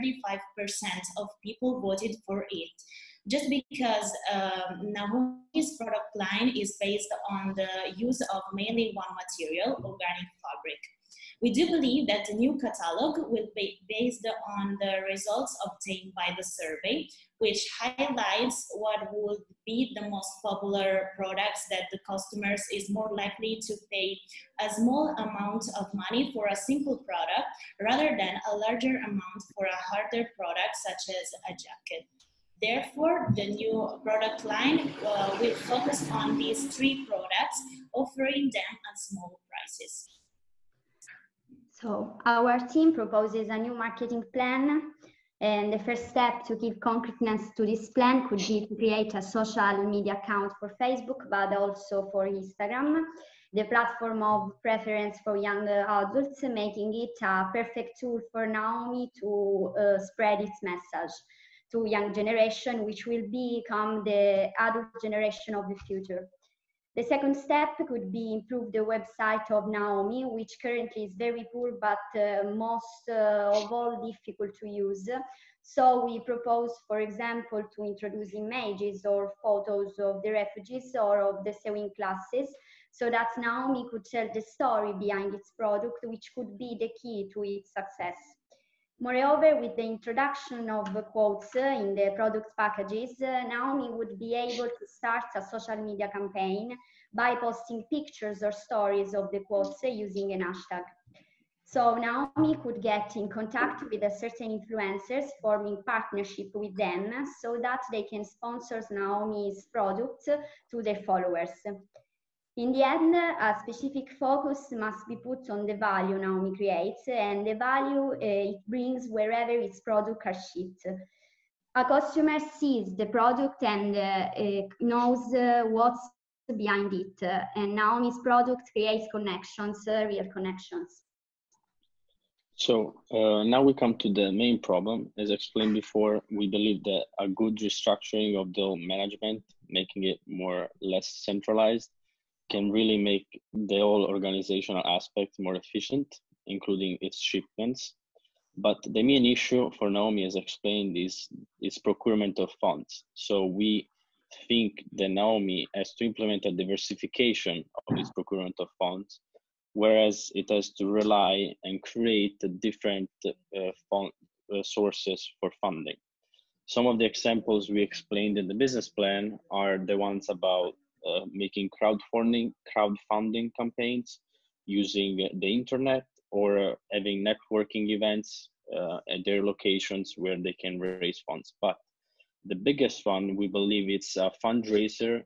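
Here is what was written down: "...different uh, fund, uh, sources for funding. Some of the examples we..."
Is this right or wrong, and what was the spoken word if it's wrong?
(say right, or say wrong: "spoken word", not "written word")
right.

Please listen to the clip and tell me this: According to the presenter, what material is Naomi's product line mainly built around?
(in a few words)
organic fabric.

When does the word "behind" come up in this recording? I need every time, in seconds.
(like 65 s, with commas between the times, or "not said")
84 s, 126 s.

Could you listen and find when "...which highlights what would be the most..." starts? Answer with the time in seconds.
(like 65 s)
17 s.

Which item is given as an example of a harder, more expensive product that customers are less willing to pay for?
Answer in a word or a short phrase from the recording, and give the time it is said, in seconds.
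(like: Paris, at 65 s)
a jacket, at 31 s.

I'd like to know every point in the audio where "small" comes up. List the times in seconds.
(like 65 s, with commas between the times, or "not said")
24 s, 38 s.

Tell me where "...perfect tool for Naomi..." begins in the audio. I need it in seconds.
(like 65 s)
57 s.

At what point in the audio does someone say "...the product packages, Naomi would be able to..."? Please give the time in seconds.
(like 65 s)
91 s.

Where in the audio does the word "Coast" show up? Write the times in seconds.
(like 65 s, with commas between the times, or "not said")
not said.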